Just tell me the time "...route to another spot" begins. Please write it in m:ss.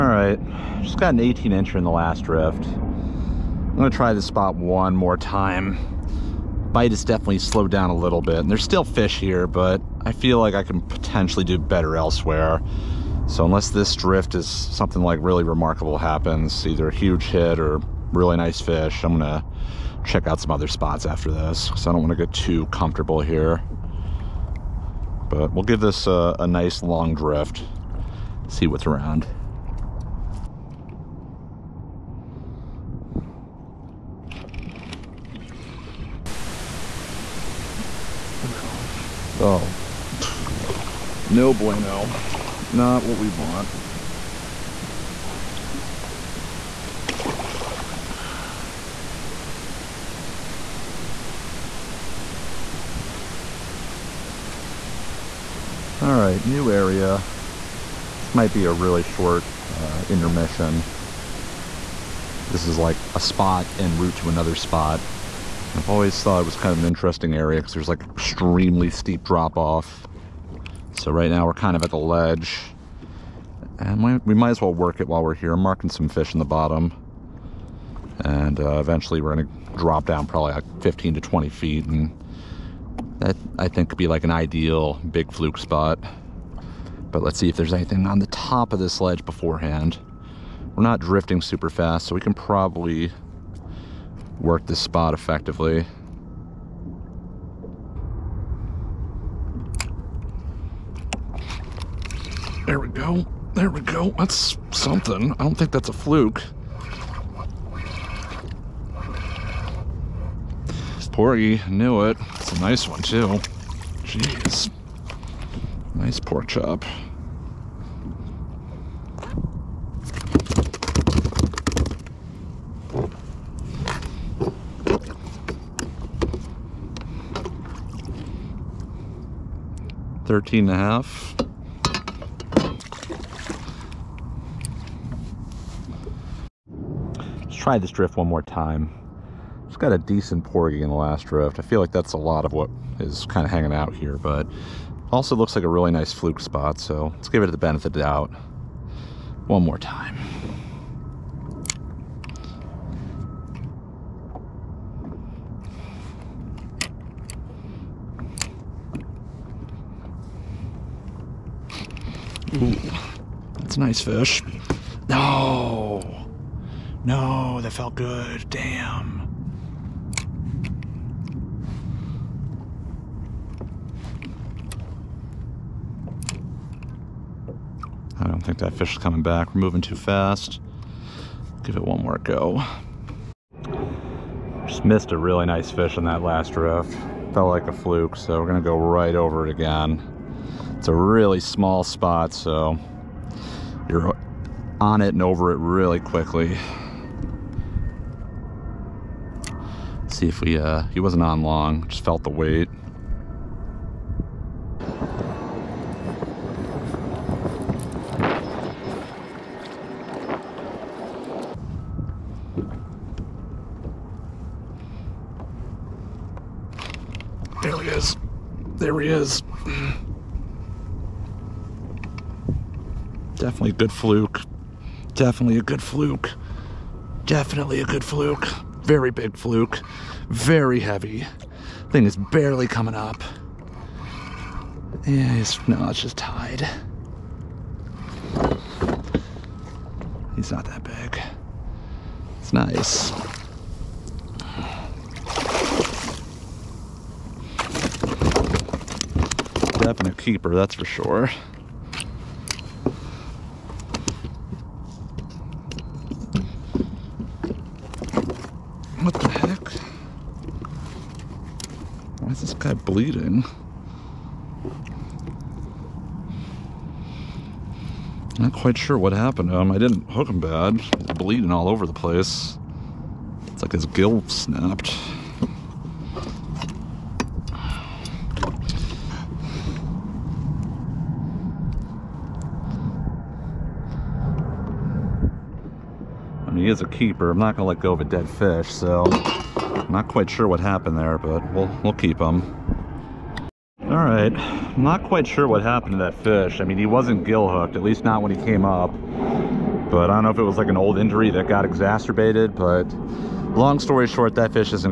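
1:03.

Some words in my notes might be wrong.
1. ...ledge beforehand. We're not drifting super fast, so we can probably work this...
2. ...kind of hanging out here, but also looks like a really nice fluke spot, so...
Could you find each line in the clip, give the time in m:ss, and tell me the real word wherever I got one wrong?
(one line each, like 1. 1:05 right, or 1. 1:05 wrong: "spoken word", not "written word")
1. 1:28 right
2. 2:23 right.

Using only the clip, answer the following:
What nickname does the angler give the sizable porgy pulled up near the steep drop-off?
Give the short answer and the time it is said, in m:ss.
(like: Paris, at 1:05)
pork chop, at 1:56.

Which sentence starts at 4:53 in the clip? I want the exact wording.
All right, I'm not quite sure what happened to that fish.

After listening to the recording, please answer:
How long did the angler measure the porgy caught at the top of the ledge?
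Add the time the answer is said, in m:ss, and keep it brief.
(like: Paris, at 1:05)
13 and a half, at 2:10.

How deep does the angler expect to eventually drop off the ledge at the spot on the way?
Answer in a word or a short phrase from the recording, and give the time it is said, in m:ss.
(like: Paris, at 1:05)
15 to 20 feet, at 1:20.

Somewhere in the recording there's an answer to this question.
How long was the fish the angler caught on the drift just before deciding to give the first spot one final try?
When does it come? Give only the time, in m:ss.
0:01.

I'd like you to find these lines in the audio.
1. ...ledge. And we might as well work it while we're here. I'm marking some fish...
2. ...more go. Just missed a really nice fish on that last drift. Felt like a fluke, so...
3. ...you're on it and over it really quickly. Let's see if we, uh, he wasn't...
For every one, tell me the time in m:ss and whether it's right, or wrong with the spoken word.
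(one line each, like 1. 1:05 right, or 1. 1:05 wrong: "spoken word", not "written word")
1. 1:11 right
2. 3:02 right
3. 3:13 right.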